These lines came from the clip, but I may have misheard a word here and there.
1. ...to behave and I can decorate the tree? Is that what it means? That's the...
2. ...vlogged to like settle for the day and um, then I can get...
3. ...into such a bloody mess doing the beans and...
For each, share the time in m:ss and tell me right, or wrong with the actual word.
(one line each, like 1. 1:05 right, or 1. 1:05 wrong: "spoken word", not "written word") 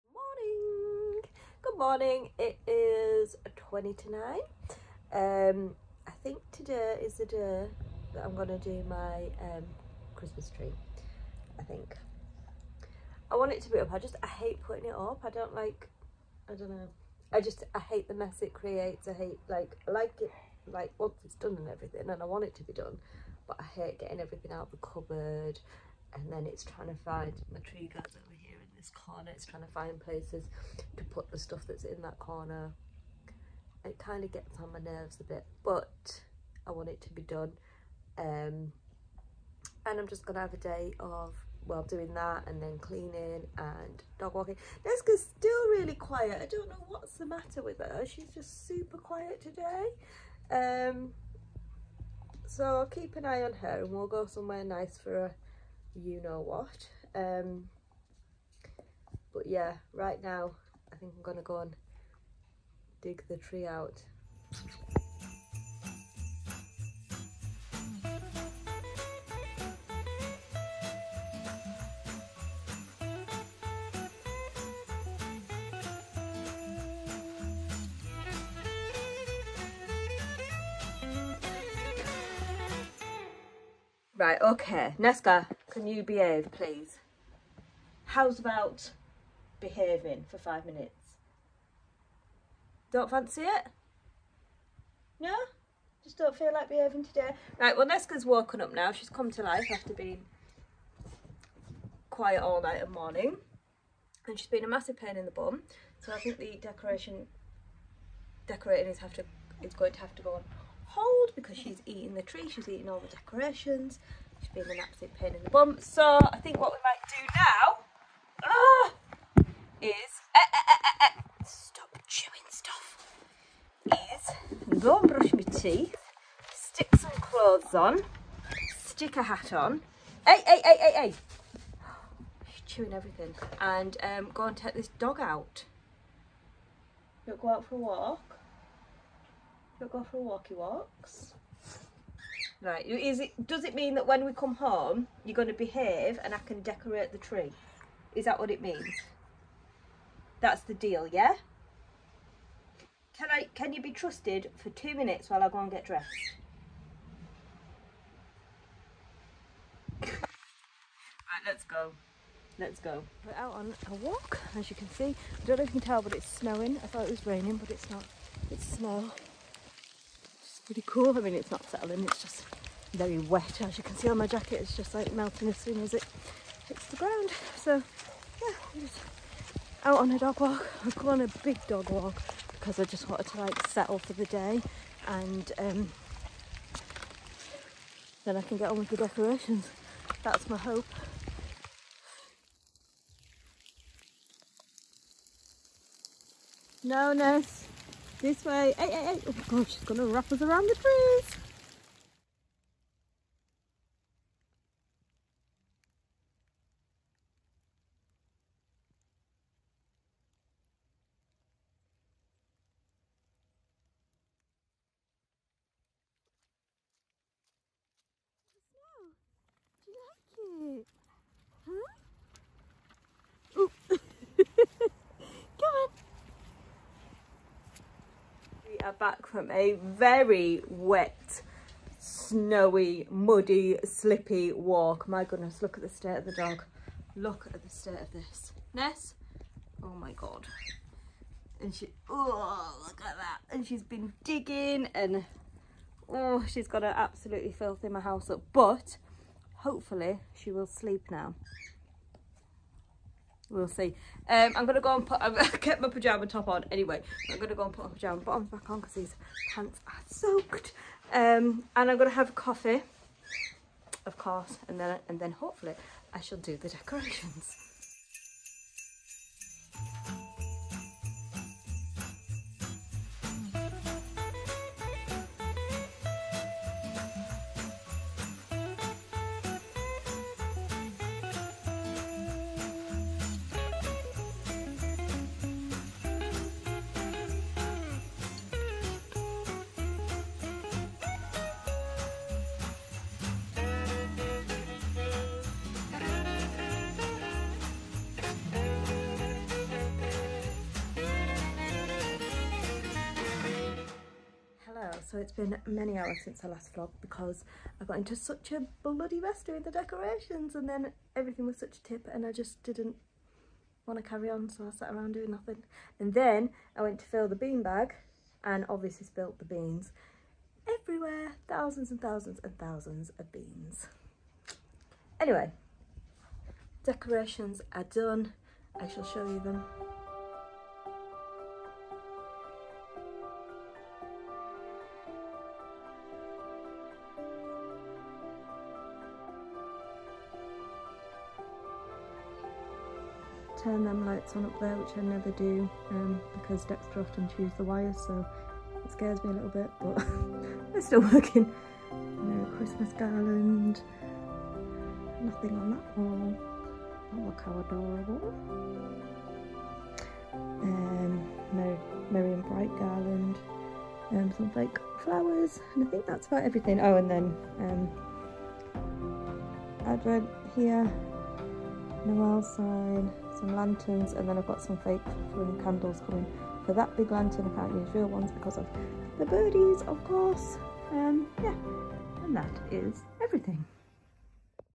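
1. 2:25 right
2. 3:03 wrong: "wanted", not "vlogged"
3. 5:07 wrong: "decorations", not "beans".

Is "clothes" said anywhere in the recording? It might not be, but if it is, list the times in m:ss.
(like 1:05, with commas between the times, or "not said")
2:07.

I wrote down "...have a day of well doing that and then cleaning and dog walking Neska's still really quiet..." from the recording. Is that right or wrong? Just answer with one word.
right.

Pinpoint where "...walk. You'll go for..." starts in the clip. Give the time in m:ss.
2:17.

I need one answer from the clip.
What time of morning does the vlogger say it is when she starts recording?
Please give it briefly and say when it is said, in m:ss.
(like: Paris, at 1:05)
20 to 9, at 0:03.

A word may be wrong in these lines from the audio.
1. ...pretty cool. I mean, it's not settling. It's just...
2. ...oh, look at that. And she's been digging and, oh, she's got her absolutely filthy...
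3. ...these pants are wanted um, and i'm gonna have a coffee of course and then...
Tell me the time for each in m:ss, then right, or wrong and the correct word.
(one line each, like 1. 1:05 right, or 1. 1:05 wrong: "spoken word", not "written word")
1. 2:50 right
2. 4:02 right
3. 4:18 wrong: "soaked", not "wanted".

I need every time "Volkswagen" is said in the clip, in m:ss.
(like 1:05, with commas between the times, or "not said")
not said.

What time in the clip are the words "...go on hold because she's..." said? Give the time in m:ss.
1:50.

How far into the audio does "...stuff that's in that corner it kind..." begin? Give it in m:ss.
0:31.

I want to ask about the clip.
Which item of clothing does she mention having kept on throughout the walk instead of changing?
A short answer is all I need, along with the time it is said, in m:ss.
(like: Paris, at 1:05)
Pajama top, at 4:15.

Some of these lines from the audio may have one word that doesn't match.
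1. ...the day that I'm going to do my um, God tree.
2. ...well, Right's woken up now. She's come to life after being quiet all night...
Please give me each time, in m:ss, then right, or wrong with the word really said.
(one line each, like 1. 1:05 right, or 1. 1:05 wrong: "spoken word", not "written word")
1. 0:07 wrong: "Christmas", not "God"
2. 1:37 wrong: "Nesca", not "Right".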